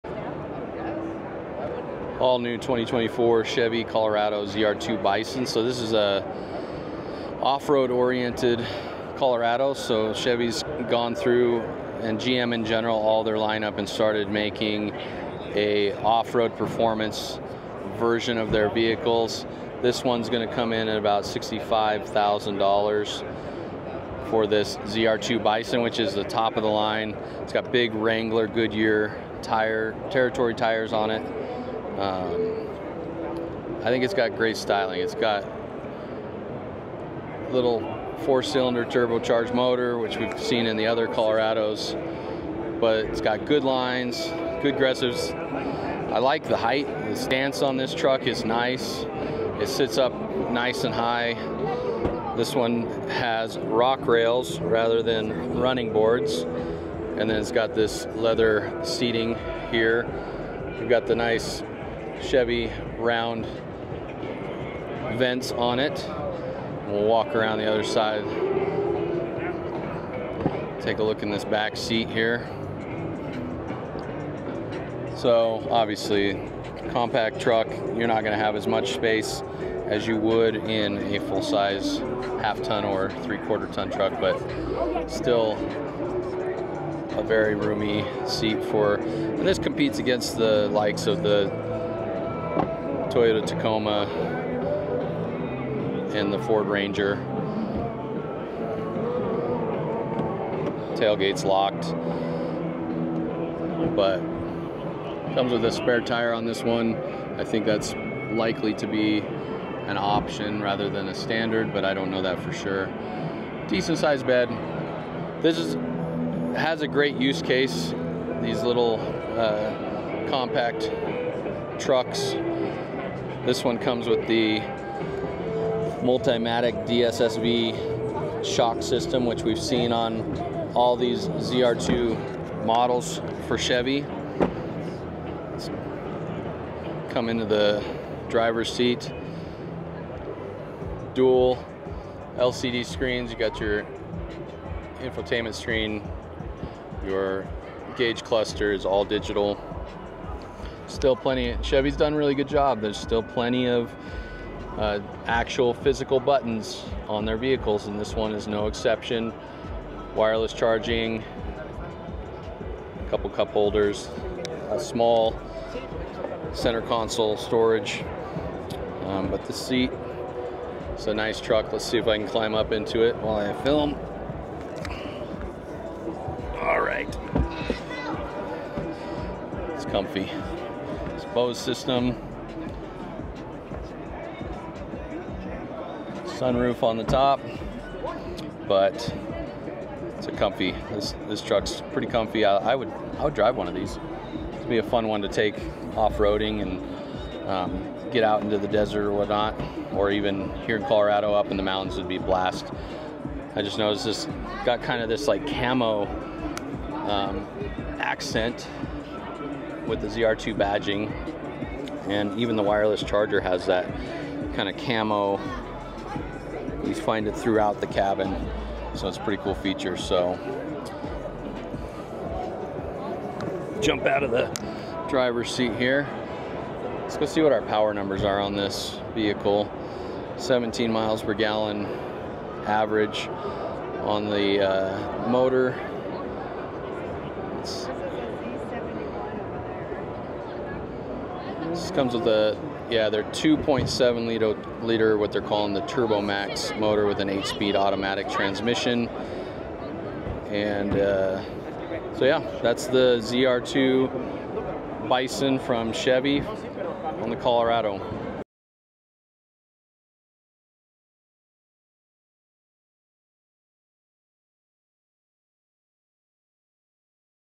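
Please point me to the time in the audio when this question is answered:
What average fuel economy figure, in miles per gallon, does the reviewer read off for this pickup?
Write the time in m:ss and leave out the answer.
3:50.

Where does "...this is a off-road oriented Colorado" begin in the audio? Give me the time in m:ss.
0:05.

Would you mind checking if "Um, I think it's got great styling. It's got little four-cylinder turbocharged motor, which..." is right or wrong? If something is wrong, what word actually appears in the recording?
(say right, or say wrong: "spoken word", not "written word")
right.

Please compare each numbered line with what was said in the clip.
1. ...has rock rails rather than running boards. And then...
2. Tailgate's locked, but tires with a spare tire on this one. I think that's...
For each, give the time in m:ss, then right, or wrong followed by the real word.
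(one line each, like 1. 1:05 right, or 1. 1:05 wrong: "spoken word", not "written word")
1. 0:53 right
2. 1:40 wrong: "comes", not "tires".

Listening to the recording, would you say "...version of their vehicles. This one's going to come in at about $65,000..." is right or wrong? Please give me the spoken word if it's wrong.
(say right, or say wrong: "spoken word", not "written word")
right.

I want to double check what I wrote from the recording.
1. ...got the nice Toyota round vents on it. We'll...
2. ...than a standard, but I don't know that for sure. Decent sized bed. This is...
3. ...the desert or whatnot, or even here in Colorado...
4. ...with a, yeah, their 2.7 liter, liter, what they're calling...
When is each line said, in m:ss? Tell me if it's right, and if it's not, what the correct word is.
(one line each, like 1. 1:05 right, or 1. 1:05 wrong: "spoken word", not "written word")
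1. 1:00 wrong: "Chevy", not "Toyota"
2. 1:50 right
3. 3:18 right
4. 4:02 right.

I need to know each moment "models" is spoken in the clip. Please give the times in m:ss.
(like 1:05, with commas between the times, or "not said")
2:12.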